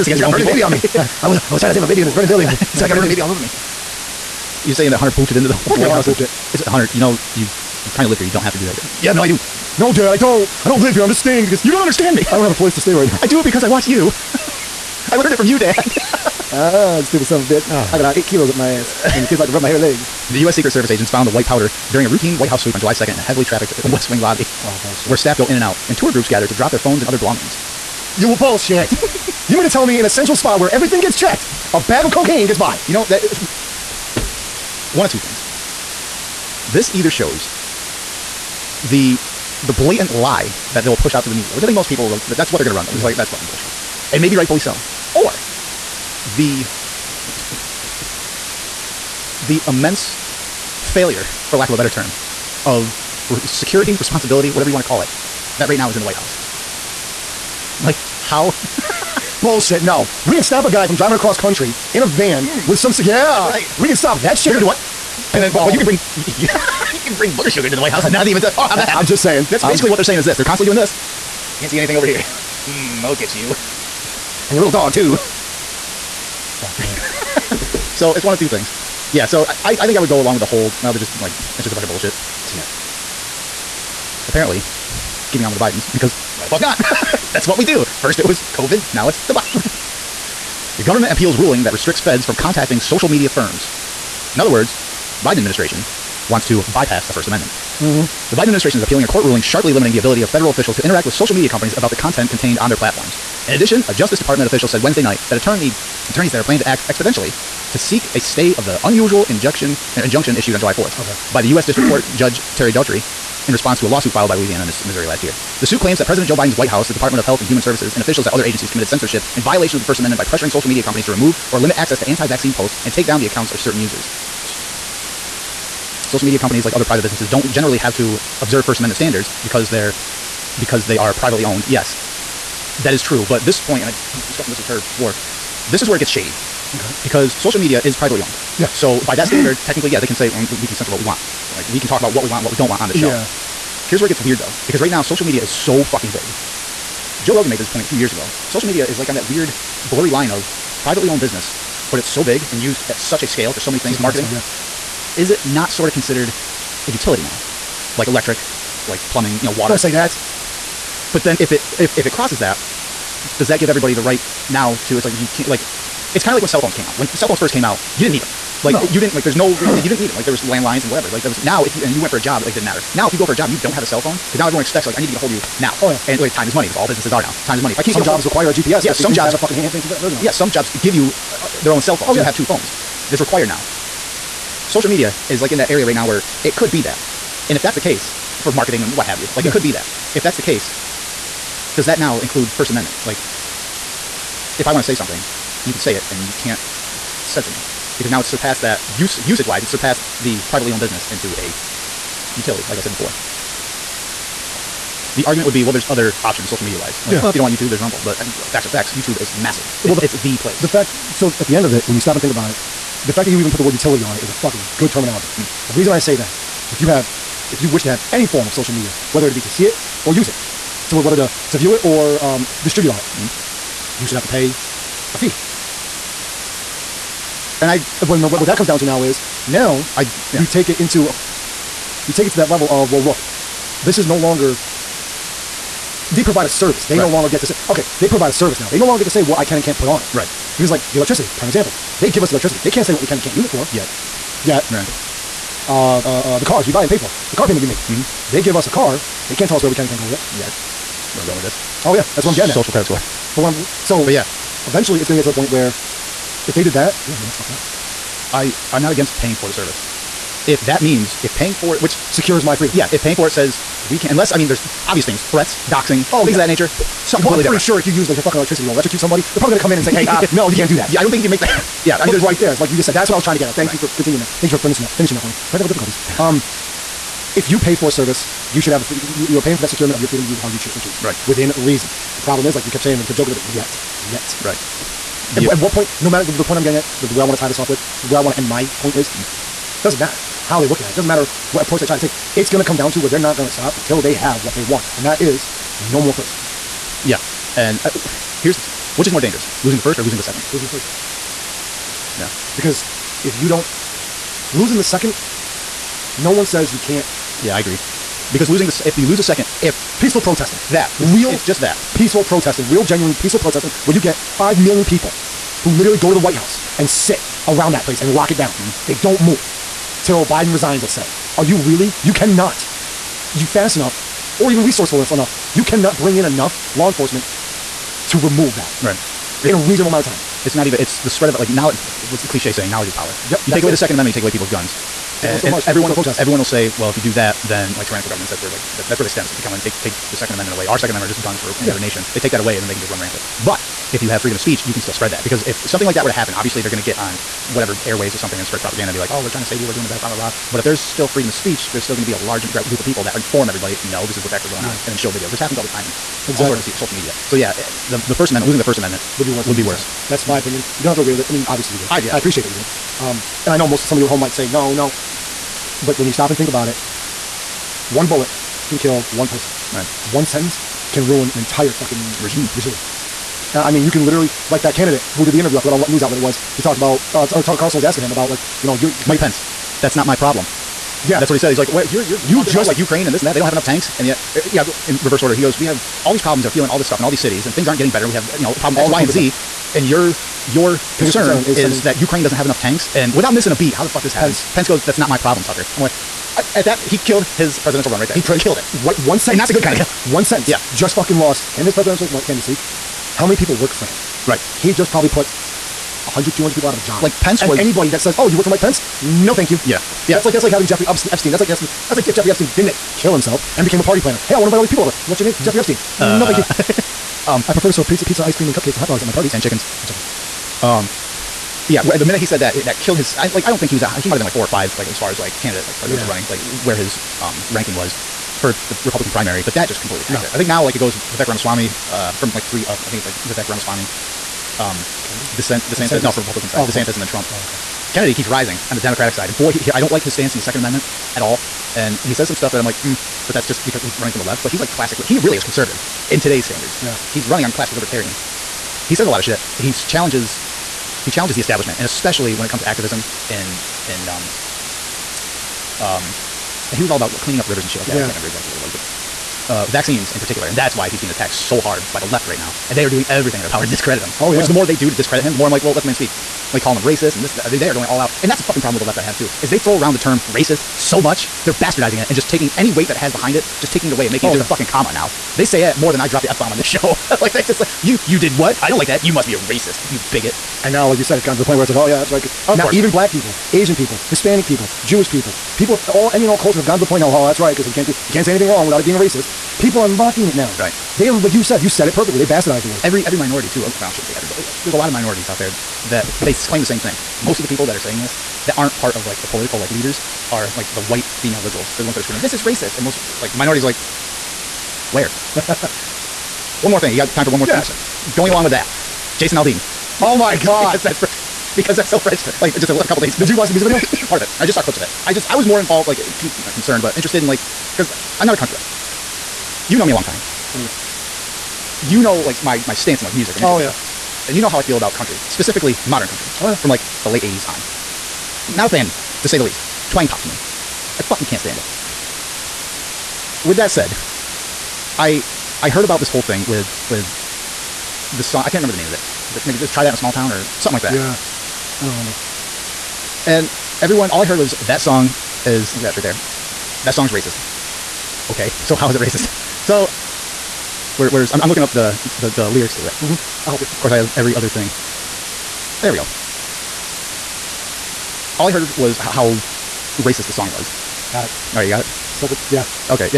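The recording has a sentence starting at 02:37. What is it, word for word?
Like electric, like plumbing, you know, water.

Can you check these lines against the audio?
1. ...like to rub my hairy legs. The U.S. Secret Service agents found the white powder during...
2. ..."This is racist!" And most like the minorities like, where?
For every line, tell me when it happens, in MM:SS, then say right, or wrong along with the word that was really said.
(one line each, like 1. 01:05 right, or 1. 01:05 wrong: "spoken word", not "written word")
1. 00:19 right
2. 08:22 right.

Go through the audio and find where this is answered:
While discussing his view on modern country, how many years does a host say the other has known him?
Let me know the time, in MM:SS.
08:40.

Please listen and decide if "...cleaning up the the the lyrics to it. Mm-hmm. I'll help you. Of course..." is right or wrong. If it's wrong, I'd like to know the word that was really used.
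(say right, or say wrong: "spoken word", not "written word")
wrong: "looking", not "cleaning".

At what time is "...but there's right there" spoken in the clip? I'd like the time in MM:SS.
04:32.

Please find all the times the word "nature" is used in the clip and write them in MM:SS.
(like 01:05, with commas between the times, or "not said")
04:26.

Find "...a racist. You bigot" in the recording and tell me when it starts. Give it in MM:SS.
07:59.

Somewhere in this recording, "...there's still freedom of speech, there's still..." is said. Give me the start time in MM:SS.
05:50.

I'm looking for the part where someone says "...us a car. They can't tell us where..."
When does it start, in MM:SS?
04:08.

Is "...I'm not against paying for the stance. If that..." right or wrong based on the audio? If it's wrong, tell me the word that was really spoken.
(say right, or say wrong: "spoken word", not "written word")
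wrong: "service", not "stance".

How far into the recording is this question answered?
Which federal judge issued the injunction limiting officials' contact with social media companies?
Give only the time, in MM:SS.
01:52.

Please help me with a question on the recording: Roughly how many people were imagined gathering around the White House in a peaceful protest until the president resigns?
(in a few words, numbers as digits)
5 million.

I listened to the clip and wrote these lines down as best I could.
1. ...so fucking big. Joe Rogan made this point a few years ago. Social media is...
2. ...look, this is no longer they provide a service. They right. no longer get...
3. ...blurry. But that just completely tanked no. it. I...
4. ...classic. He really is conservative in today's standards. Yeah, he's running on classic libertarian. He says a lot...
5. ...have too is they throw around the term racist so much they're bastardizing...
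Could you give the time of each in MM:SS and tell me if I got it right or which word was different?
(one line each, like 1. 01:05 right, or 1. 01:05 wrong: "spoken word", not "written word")
1. 02:25 right
2. 03:53 right
3. 07:09 wrong: "primary", not "blurry"
4. 07:24 right
5. 07:49 right.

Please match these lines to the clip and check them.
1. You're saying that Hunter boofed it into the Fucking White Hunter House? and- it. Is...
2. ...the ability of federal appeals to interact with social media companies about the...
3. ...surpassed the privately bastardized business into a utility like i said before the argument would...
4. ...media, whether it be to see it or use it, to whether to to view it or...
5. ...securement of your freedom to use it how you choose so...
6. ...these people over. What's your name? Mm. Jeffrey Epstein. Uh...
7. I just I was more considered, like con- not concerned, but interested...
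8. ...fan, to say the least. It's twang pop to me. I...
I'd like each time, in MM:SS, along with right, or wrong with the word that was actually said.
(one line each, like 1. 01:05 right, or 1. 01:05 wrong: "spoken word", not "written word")
1. 00:04 right
2. 01:39 wrong: "officials", not "appeals"
3. 03:19 wrong: "owned", not "bastardized"
4. 03:38 right
5. 04:39 right
6. 06:54 right
7. 08:35 wrong: "involved", not "considered"
8. 08:48 right.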